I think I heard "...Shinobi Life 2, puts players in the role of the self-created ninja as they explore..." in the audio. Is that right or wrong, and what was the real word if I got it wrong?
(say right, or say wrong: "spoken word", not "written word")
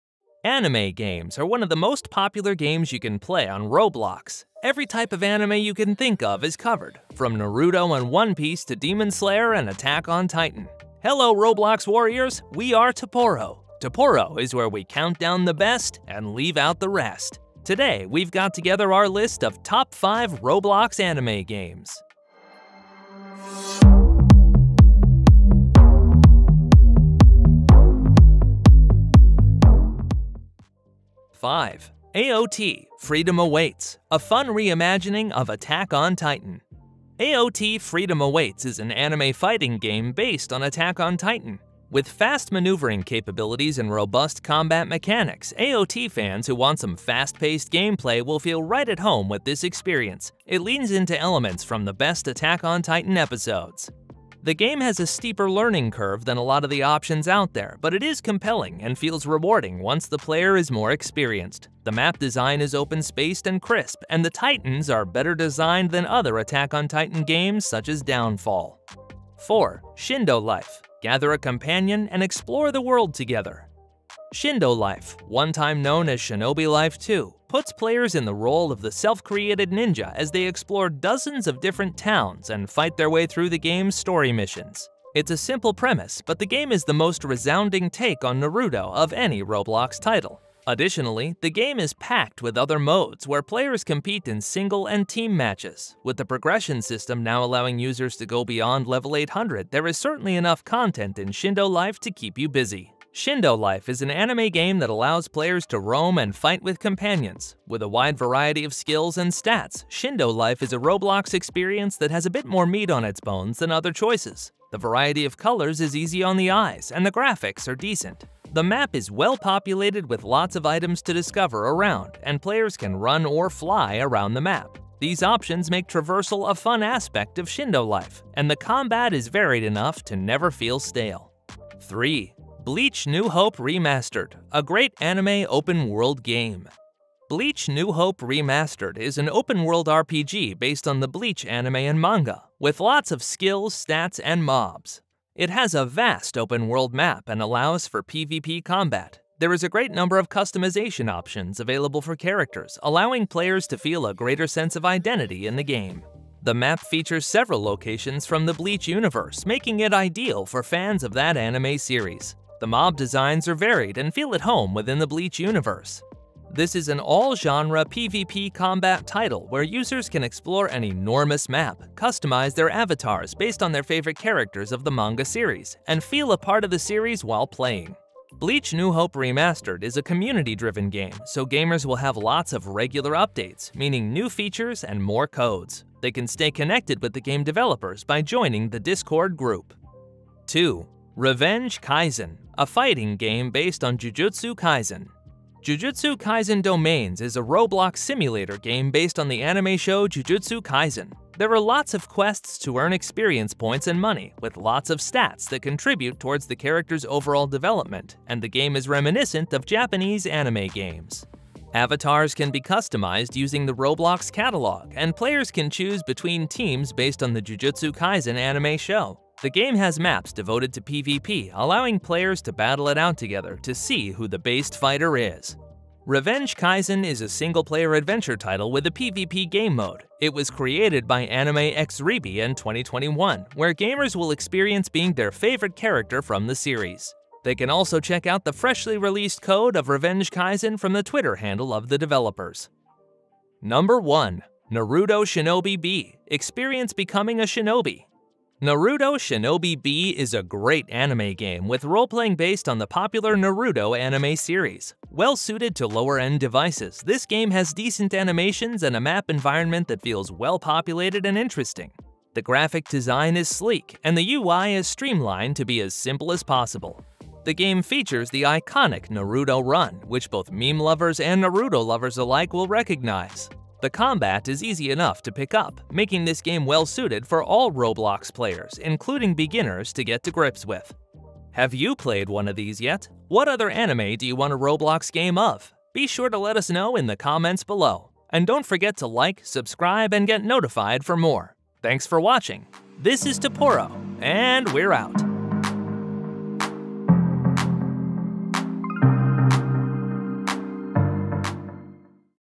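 right.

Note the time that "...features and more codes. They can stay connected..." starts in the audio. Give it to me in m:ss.
3:04.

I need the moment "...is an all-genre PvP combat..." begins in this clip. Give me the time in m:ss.
2:46.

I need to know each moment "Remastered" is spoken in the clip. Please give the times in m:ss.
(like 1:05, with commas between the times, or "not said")
2:13, 2:18, 2:59.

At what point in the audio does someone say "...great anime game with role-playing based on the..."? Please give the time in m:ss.
4:10.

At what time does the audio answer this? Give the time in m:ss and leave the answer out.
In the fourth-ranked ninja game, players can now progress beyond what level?
1:38.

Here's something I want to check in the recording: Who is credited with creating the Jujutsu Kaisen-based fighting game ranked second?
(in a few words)
Anime X Rebi.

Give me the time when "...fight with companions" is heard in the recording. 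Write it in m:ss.
1:46.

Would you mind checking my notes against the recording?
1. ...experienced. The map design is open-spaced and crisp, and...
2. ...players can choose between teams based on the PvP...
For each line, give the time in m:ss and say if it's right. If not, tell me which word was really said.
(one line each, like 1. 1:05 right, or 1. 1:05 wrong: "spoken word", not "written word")
1. 1:00 right
2. 3:35 wrong: "Jujutsu", not "PvP".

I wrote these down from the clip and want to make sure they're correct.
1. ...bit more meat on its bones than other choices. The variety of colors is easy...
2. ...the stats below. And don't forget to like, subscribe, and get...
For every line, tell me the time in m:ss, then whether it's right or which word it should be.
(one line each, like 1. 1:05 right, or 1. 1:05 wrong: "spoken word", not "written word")
1. 1:52 right
2. 4:47 wrong: "comments", not "stats".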